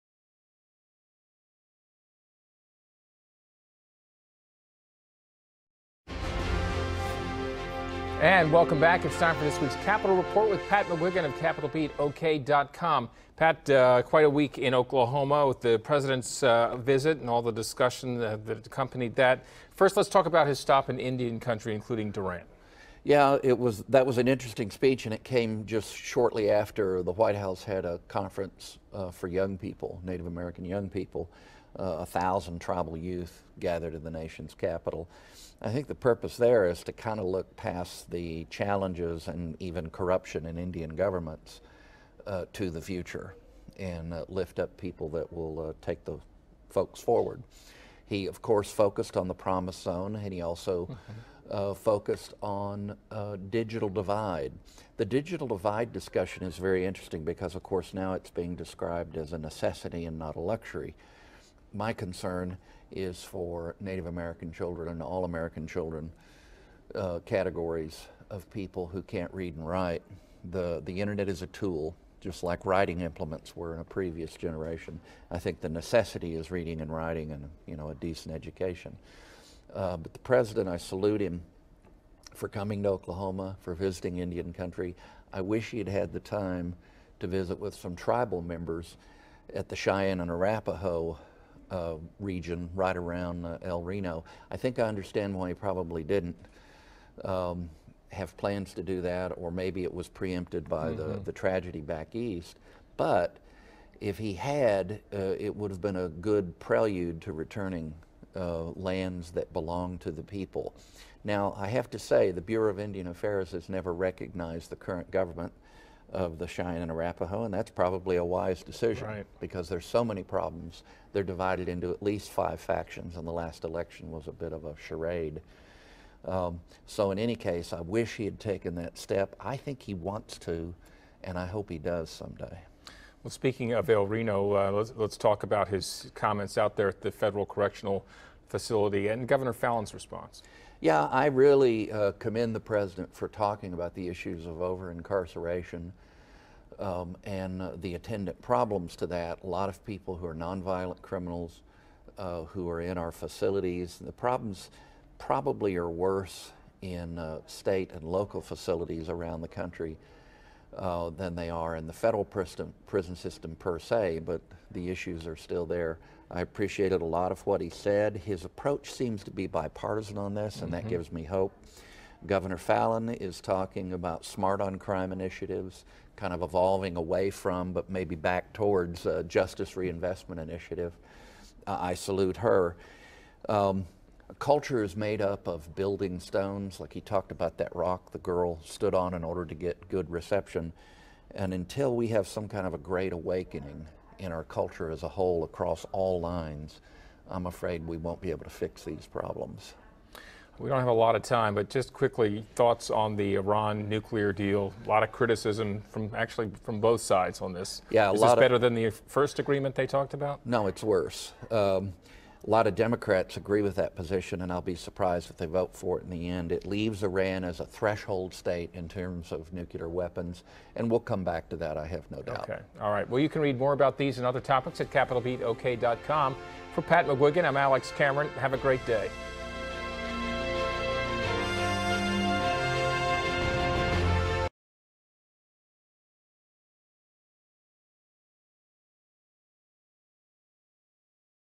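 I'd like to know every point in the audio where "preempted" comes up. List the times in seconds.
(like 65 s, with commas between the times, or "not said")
100 s.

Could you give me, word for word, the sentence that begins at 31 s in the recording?
Uh, a thousand tribal youth gathered in the nation's capital.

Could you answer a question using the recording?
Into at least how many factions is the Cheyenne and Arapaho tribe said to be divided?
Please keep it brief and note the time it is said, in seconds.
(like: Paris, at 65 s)
5, at 122 s.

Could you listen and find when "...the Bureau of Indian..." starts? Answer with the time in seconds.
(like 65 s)
112 s.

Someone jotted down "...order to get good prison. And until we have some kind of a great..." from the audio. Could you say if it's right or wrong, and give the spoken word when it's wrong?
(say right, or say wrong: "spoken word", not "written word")
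wrong: "reception", not "prison".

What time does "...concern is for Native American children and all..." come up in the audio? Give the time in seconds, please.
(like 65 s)
61 s.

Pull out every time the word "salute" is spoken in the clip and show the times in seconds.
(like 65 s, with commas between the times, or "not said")
80 s, 181 s.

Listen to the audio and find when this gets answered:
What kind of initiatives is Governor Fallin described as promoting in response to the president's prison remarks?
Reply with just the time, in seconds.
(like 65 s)
174 s.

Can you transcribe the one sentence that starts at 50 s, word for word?
Mm -hmm uh, focused on uh, digital divide.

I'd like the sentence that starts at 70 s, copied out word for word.
The, the internet is a tool, just like writing implements were in a previous generation.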